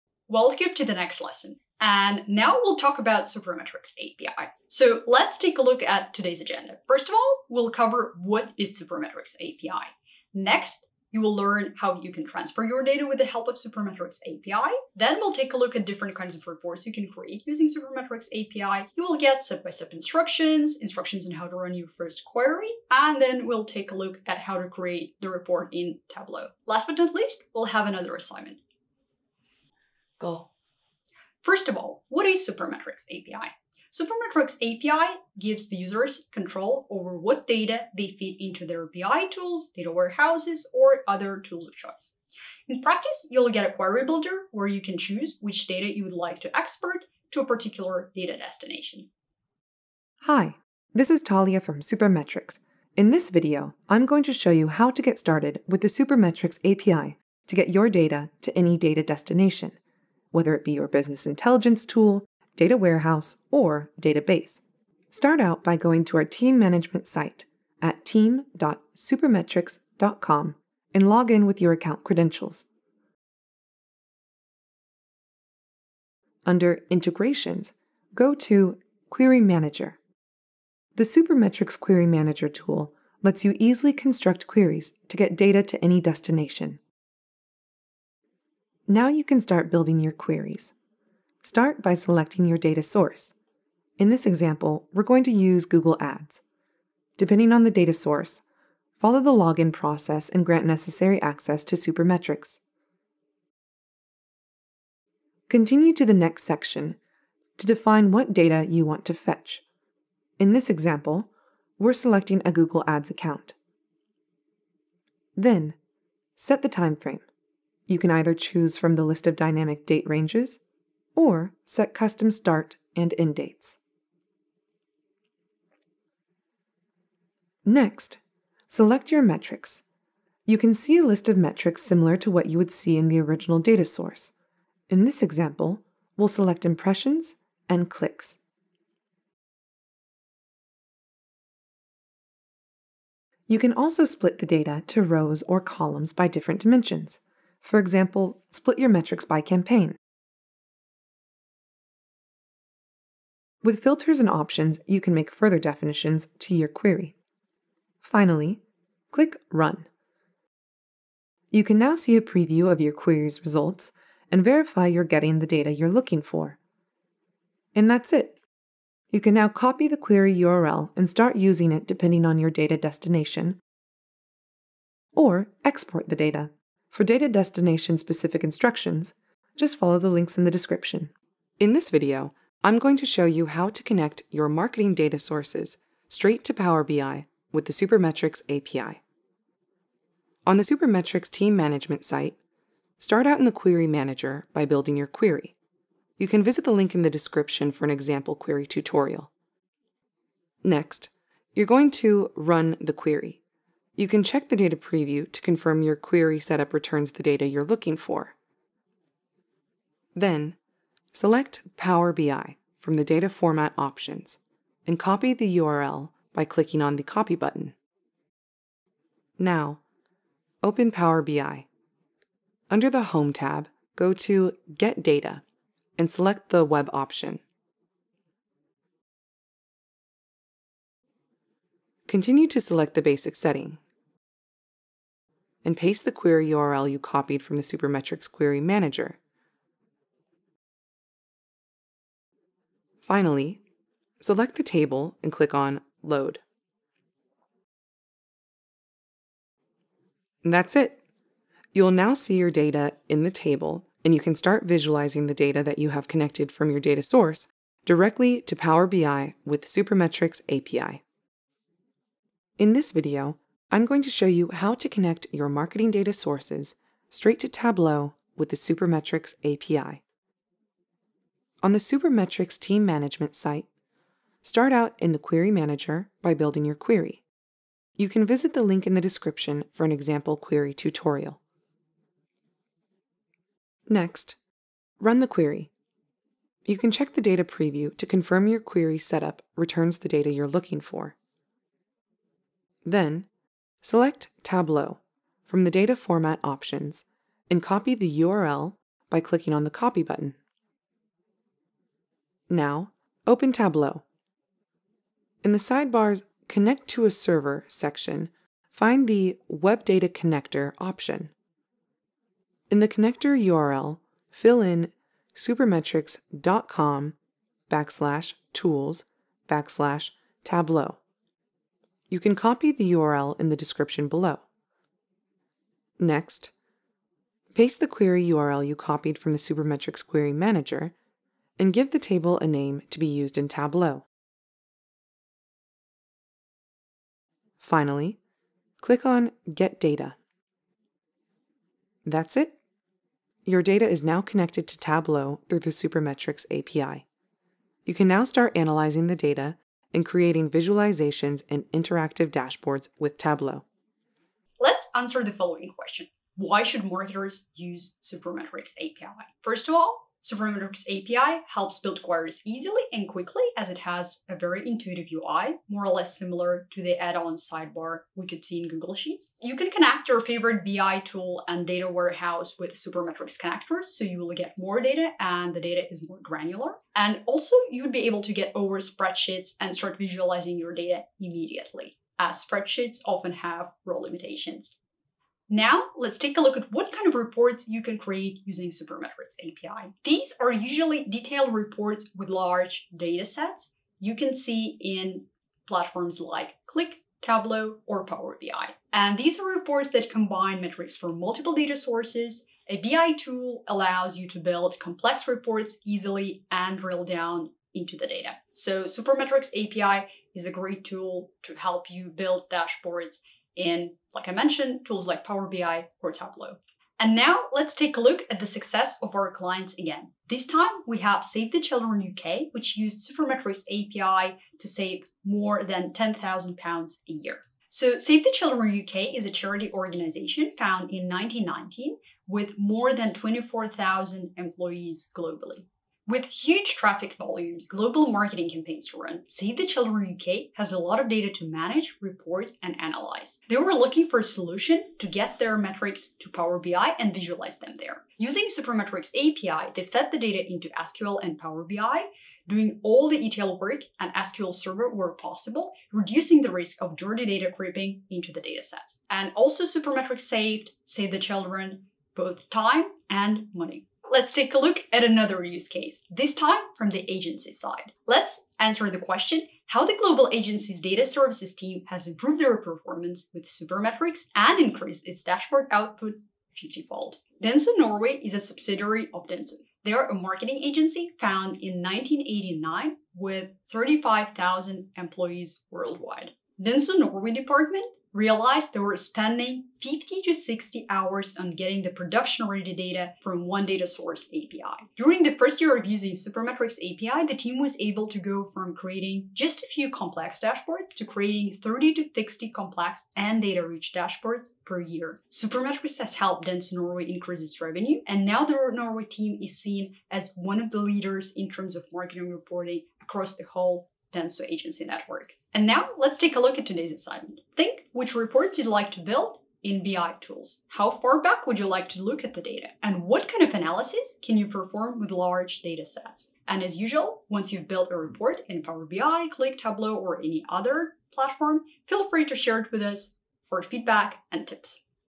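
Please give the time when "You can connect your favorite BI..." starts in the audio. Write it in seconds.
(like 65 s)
369 s.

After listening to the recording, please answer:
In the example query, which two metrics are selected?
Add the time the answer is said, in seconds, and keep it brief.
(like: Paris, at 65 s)
Impressions and clicks, at 136 s.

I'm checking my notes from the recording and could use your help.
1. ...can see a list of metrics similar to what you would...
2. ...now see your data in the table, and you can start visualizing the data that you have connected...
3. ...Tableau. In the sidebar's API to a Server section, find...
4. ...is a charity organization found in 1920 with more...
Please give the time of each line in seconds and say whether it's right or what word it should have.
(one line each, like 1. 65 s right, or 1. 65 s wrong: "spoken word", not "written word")
1. 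130 s right
2. 251 s right
3. 303 s wrong: "Connect", not "API"
4. 429 s wrong: "1919", not "1920".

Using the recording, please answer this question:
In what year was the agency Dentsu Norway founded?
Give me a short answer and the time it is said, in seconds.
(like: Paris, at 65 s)
1989, at 481 s.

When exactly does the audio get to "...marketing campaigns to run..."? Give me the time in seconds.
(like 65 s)
438 s.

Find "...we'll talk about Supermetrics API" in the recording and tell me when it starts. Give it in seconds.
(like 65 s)
2 s.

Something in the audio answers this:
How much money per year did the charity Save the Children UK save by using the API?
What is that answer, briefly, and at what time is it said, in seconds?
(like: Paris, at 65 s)
£10,000, at 425 s.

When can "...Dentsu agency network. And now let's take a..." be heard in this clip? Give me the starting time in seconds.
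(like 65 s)
514 s.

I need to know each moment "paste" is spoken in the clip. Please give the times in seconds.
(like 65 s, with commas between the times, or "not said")
235 s, 327 s.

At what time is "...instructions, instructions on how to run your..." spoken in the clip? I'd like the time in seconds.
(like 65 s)
19 s.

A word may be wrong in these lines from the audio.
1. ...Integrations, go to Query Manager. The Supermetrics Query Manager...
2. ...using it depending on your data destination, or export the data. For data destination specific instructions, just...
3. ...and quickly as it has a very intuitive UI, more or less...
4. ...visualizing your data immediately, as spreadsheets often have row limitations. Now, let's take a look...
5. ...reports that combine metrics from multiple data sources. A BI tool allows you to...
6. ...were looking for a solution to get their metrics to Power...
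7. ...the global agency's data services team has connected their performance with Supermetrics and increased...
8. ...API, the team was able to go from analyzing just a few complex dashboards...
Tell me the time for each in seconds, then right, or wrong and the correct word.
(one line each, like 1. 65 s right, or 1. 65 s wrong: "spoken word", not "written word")
1. 76 s right
2. 171 s right
3. 362 s right
4. 379 s right
5. 399 s right
6. 443 s right
7. 469 s wrong: "improved", not "connected"
8. 496 s wrong: "creating", not "analyzing".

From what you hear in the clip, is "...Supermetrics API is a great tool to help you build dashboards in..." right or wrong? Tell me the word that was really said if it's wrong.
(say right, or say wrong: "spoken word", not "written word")
right.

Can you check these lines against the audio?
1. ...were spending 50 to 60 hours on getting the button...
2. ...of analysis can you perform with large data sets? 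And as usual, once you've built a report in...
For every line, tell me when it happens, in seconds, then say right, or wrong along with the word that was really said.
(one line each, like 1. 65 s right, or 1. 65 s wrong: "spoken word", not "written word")
1. 488 s wrong: "production", not "button"
2. 523 s right.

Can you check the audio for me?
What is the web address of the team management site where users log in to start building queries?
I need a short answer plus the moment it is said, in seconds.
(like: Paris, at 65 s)
team.supermetrics.com, at 68 s.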